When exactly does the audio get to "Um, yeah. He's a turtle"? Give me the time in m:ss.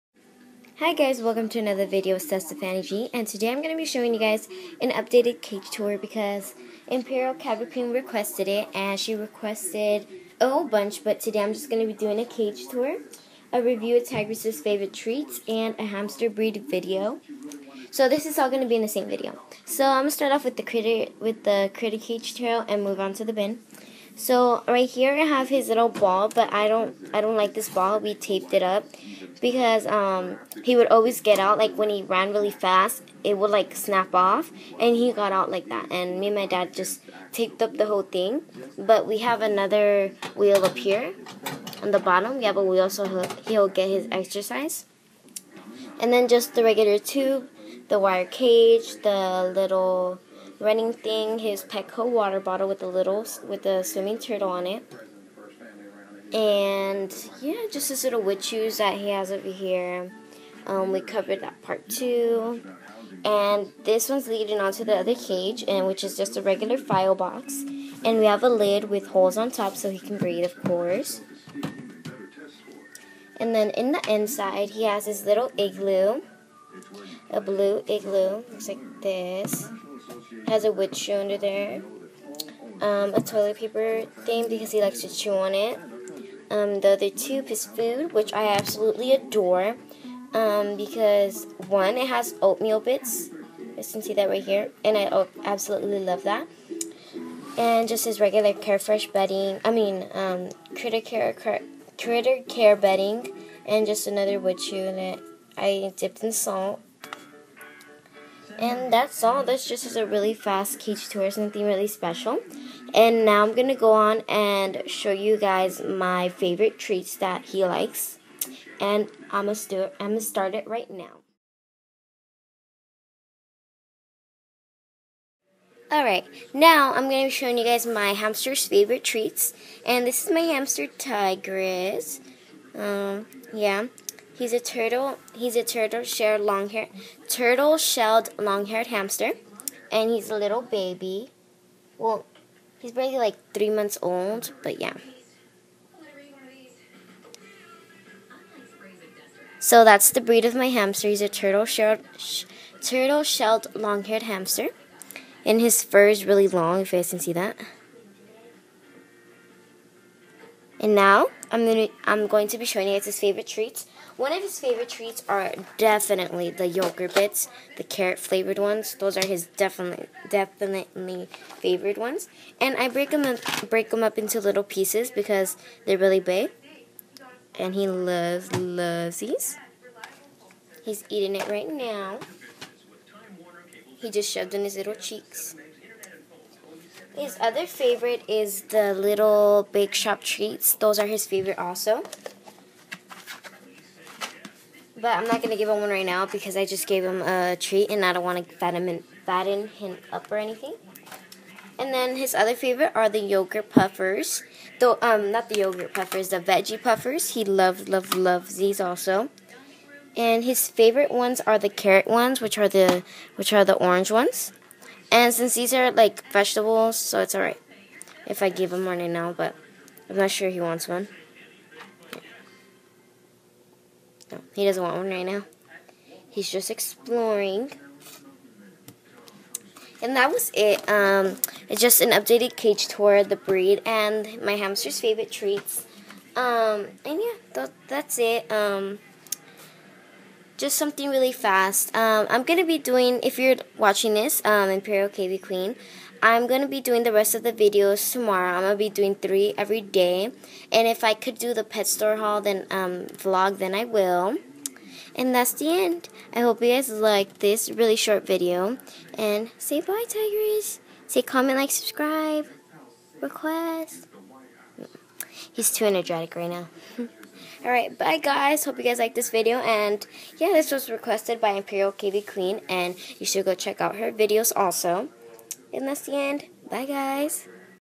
2:12.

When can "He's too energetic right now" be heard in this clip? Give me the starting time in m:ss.
4:25.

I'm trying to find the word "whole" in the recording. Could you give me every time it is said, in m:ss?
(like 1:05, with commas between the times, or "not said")
0:10, 0:37.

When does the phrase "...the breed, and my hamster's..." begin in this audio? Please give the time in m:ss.
3:53.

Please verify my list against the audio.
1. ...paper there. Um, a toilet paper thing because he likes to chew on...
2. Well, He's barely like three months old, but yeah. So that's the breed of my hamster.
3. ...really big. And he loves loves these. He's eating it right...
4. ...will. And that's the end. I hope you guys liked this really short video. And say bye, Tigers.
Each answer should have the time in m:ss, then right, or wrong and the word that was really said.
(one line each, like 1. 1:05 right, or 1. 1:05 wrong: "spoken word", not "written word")
1. 1:21 wrong: "under", not "paper"
2. 2:21 right
3. 2:55 right
4. 4:13 right.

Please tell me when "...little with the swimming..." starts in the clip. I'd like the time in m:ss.
0:52.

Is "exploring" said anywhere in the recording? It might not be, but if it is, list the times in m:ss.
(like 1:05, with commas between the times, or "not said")
3:46.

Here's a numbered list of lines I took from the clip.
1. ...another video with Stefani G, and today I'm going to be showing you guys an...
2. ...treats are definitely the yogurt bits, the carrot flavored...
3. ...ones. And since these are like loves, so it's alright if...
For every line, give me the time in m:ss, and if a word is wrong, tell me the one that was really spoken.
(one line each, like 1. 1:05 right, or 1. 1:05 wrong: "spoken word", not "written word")
1. 0:01 right
2. 2:44 right
3. 3:34 wrong: "vegetables", not "loves".